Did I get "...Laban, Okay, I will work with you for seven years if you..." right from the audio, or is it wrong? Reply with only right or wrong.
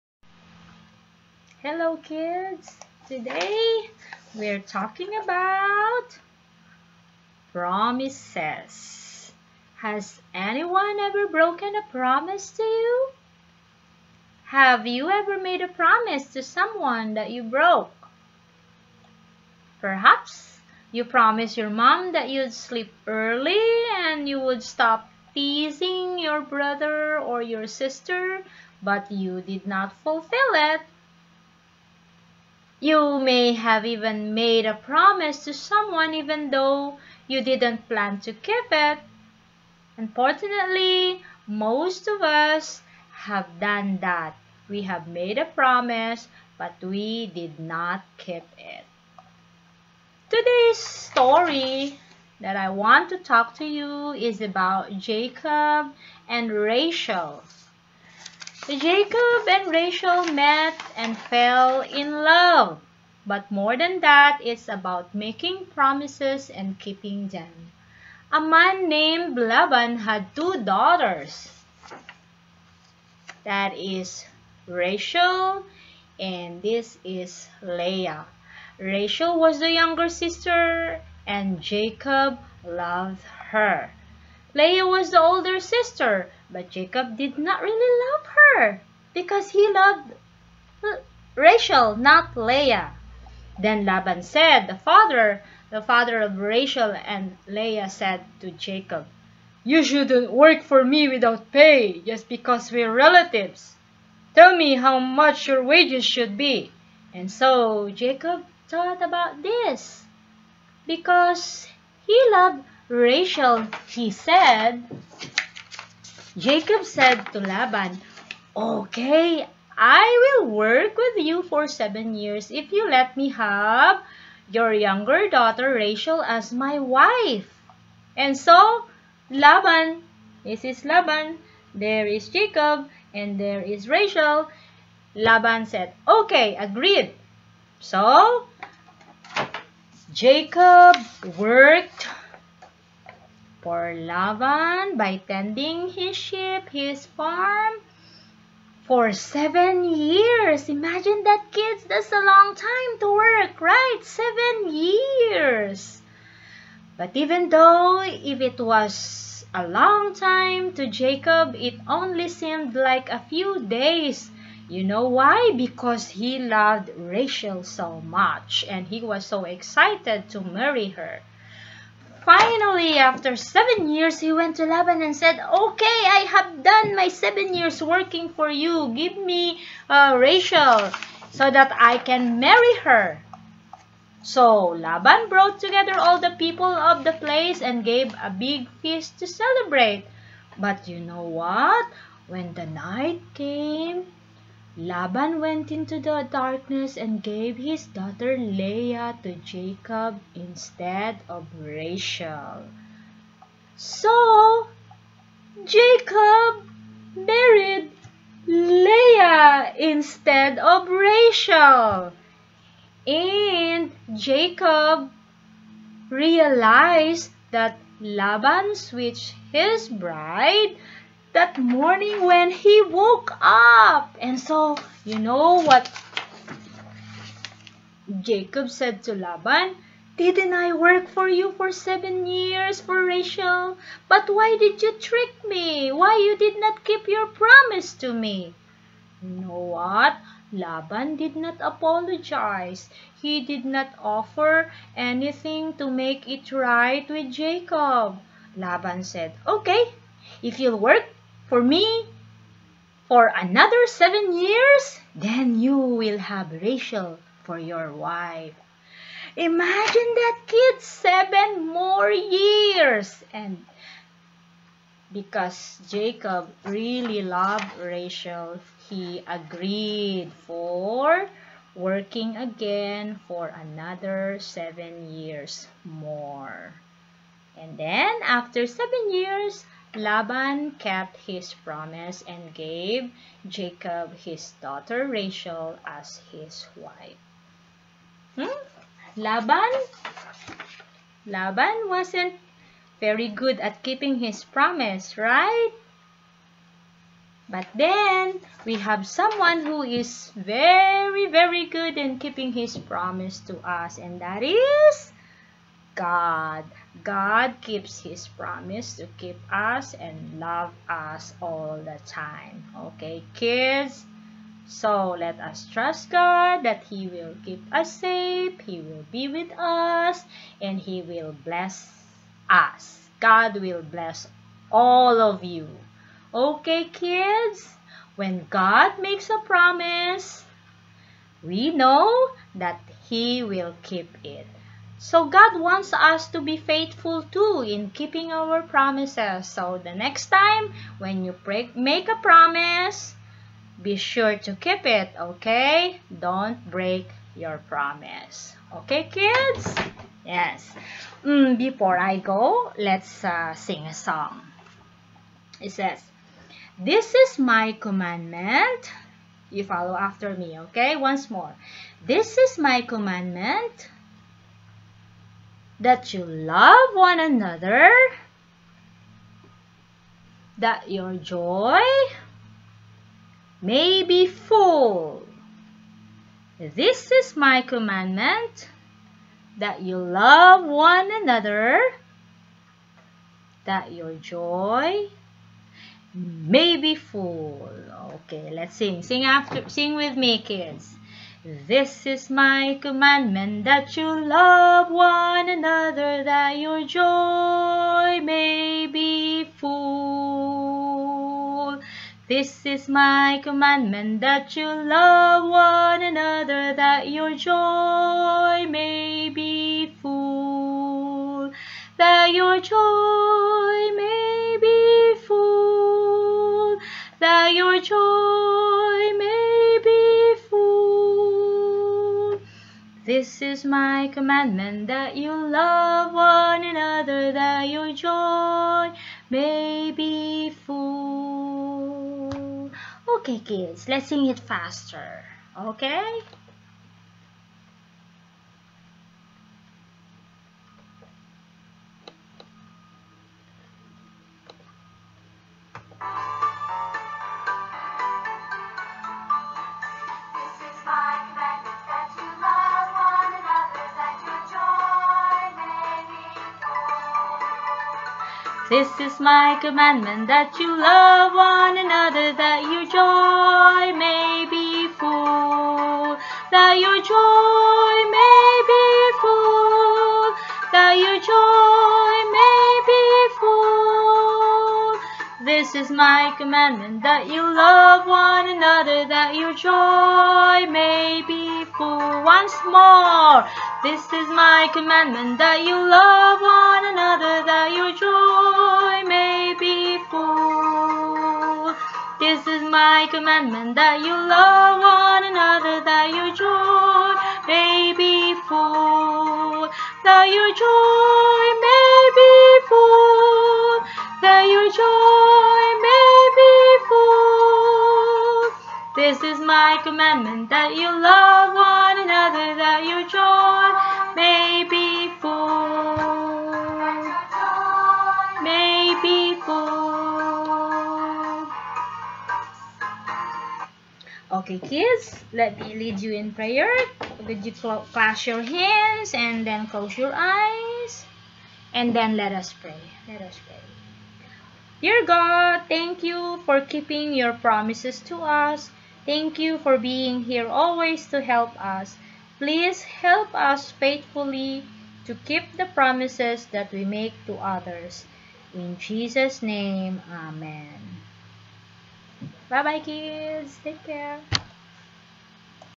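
right.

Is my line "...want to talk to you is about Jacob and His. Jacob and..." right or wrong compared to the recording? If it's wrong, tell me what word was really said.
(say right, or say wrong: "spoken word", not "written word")
wrong: "Rachel", not "His".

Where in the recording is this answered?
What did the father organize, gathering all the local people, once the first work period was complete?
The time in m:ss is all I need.
3:08.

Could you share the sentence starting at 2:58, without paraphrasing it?
Give me uh, Rachel so that I can marry her.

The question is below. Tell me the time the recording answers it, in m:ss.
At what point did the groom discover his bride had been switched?
3:41.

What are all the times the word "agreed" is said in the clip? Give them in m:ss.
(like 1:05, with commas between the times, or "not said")
2:16, 4:29.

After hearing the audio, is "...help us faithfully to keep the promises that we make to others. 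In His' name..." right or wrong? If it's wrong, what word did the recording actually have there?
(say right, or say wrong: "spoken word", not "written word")
wrong: "Jesus", not "His".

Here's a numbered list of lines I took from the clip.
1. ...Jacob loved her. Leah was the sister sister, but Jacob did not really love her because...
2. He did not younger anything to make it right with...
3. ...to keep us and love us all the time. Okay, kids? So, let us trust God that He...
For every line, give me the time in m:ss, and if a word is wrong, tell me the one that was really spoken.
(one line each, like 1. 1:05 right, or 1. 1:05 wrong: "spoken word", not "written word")
1. 1:21 wrong: "older", not "sister"
2. 4:03 wrong: "offer", not "younger"
3. 5:08 right.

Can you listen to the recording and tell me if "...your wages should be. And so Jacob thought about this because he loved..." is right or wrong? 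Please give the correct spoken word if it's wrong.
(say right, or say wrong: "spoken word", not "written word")
right.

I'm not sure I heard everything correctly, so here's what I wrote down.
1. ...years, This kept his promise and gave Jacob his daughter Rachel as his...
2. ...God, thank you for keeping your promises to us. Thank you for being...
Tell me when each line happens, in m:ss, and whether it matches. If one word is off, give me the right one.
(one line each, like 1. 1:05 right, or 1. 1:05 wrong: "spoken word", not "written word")
1. 4:39 wrong: "Laban", not "This"
2. 8:55 right.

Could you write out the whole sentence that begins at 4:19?
Imagine that kid seven more years.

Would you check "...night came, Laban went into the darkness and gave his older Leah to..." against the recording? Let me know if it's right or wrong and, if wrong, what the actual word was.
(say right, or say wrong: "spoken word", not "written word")
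wrong: "daughter", not "older".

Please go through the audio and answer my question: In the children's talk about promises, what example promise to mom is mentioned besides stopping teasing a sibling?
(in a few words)
sleep early.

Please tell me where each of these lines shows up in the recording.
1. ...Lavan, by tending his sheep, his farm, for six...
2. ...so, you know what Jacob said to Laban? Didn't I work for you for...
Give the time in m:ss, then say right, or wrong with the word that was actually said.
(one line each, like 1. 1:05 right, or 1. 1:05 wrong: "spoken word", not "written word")
1. 2:23 wrong: "seven", not "six"
2. 3:44 right.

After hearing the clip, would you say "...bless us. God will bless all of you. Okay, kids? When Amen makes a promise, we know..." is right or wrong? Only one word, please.
wrong.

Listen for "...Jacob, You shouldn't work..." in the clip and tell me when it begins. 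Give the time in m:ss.
1:38.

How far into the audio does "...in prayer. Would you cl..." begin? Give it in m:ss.
8:46.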